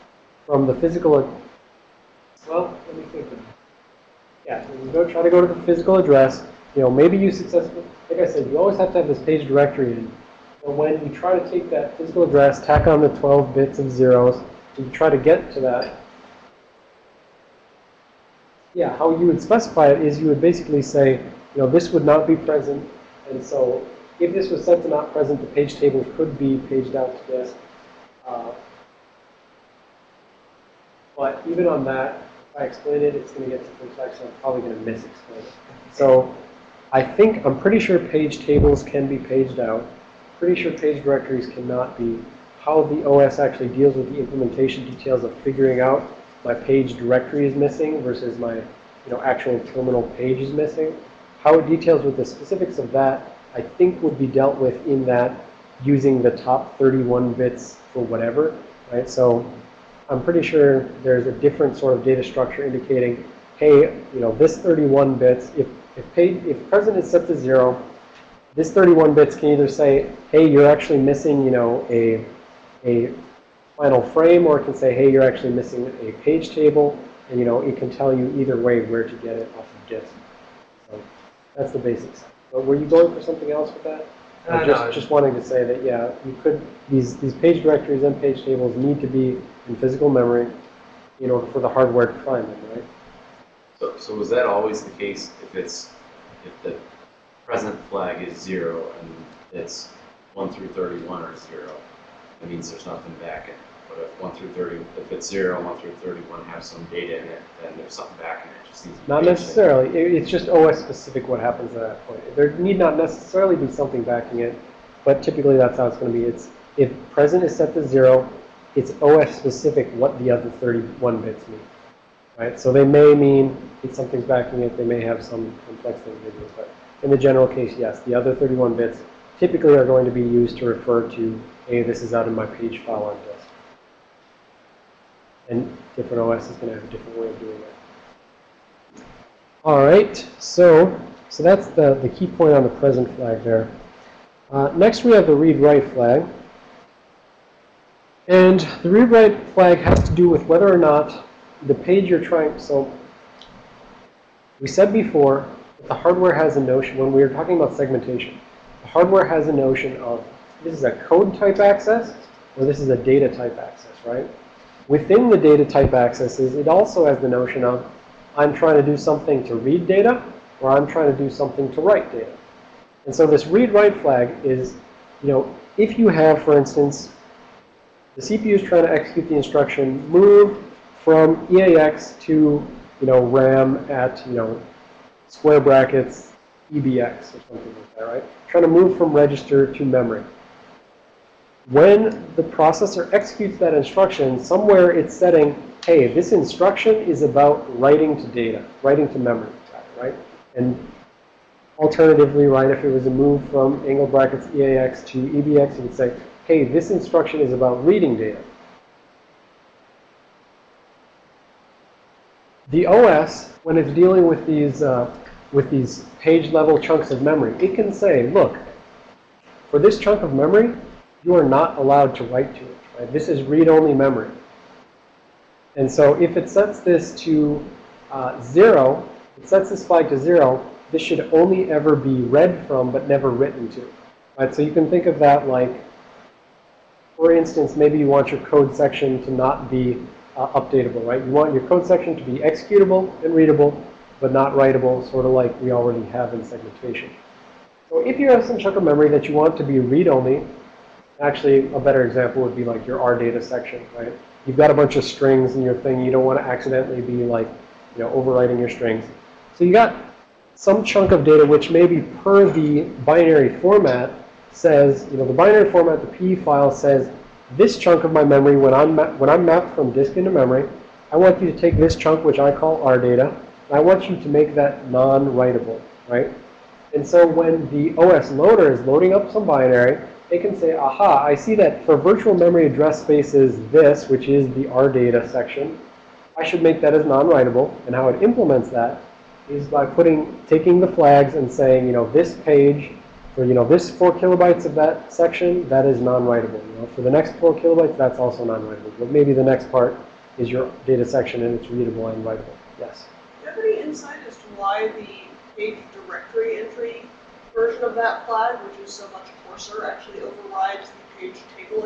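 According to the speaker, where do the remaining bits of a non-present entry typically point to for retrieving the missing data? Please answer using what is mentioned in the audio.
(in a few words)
page file on disk.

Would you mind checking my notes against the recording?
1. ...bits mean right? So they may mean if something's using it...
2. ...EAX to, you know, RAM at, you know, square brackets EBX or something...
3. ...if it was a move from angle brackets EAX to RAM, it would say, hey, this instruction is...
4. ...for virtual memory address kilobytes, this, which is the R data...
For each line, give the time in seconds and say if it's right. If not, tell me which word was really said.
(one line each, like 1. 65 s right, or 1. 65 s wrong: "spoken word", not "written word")
1. 121 s wrong: "backing", not "using"
2. 181 s right
3. 202 s wrong: "EBX", not "RAM"
4. 281 s wrong: "spaces", not "kilobytes".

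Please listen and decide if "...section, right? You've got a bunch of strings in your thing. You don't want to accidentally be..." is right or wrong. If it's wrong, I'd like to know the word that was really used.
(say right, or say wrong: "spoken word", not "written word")
right.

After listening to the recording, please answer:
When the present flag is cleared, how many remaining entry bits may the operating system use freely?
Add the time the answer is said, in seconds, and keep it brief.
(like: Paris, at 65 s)
31, at 56 s.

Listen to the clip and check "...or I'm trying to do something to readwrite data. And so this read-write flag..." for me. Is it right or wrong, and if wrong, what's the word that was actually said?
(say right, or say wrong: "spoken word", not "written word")
wrong: "write", not "readwrite".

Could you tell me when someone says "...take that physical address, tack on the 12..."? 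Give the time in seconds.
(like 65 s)
11 s.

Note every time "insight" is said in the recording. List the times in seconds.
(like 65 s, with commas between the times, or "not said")
303 s.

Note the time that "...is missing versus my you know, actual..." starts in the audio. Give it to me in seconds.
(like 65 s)
47 s.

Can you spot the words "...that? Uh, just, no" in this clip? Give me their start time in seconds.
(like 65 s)
83 s.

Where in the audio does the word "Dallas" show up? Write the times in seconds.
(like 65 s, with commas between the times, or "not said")
not said.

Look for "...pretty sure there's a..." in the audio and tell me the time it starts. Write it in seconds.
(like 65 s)
60 s.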